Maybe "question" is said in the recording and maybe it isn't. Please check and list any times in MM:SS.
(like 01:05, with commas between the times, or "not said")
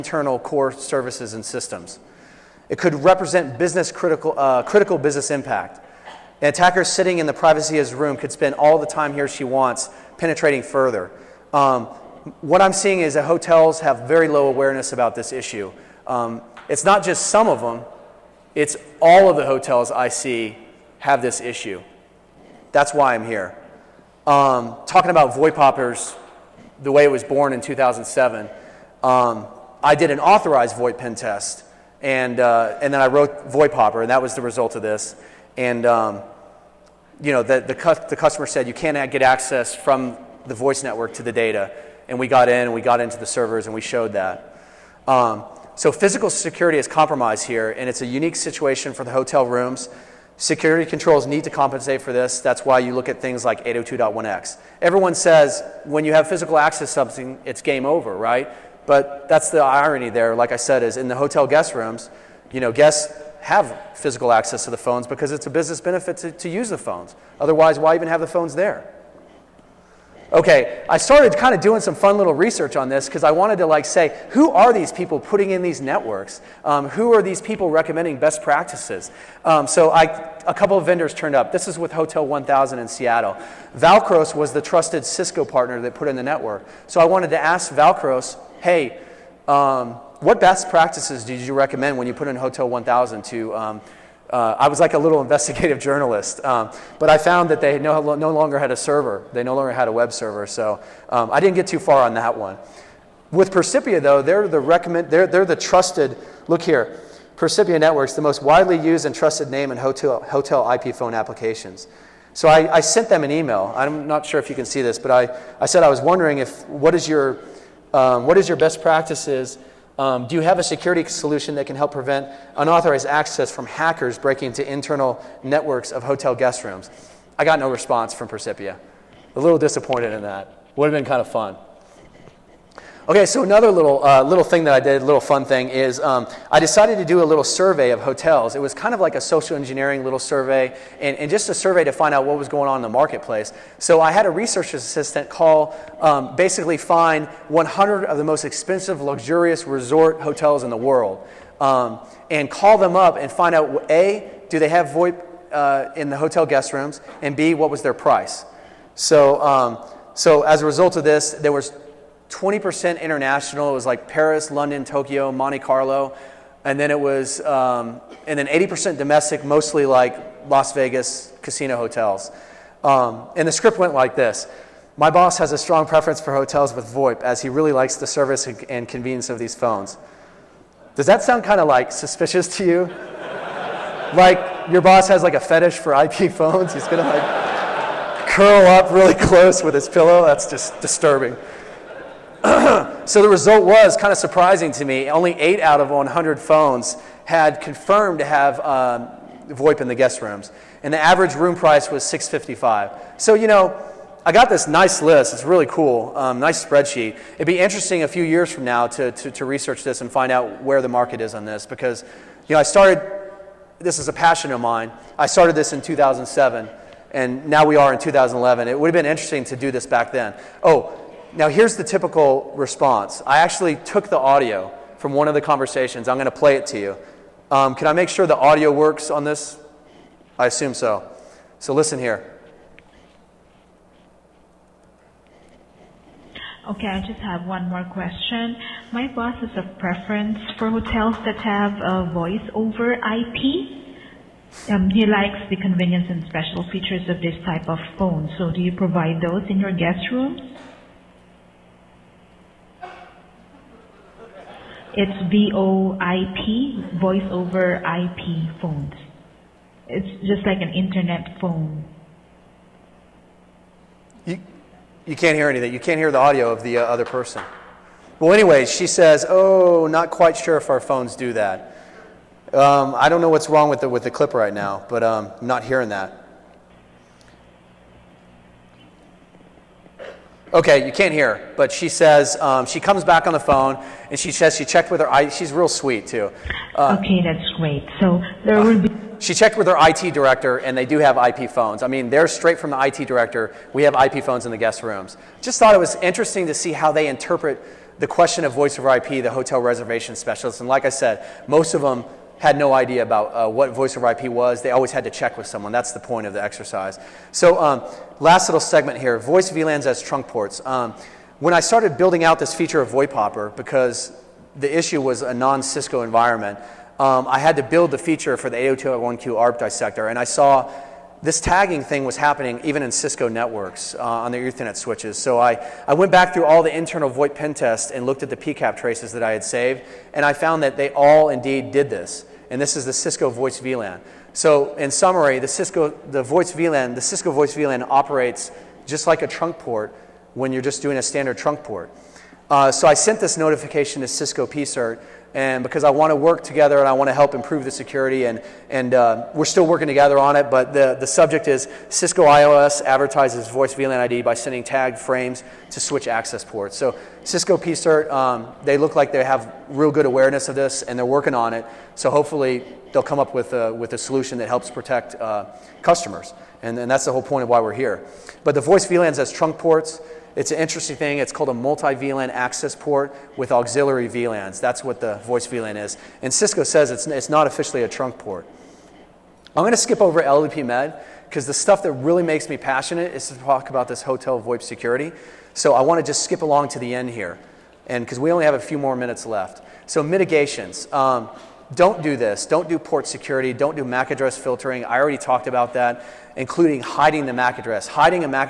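03:57, 04:58.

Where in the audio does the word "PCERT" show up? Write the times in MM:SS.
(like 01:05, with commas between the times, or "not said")
05:44, 05:57.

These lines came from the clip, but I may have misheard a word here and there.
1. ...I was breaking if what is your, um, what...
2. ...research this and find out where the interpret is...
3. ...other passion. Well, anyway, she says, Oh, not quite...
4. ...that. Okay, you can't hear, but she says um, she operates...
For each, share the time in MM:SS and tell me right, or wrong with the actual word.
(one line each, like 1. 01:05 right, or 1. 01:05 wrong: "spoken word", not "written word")
1. 01:55 wrong: "wondering", not "breaking"
2. 03:29 wrong: "market", not "interpret"
3. 04:26 wrong: "person", not "passion"
4. 04:35 wrong: "comes", not "operates".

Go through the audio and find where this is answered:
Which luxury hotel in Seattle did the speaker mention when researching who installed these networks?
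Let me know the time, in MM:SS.
01:21.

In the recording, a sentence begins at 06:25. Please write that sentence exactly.
So I want to just skip along to the end here, and because we only have a few more minutes left.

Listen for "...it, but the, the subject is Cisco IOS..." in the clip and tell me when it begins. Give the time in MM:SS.
05:50.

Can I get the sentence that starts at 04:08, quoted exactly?
So, do you provide those in your guest rooms?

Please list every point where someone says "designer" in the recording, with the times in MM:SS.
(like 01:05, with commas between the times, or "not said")
not said.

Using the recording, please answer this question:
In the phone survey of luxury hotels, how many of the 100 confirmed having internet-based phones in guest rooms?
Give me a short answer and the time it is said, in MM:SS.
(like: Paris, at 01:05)
8, at 03:15.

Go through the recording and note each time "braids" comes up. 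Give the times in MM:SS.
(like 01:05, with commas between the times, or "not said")
not said.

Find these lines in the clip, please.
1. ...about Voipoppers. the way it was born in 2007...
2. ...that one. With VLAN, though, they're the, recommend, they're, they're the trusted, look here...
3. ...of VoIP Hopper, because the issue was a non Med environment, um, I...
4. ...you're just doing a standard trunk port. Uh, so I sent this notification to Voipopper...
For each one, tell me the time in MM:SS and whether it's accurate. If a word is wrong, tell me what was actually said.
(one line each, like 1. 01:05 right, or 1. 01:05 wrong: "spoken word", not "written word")
1. 00:25 right
2. 01:42 wrong: "Percipia", not "VLAN"
3. 05:12 wrong: "Cisco", not "Med"
4. 05:40 wrong: "Cisco", not "Voipopper".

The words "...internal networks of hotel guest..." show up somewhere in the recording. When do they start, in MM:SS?
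02:04.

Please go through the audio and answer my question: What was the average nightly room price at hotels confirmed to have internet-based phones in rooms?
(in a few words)
655.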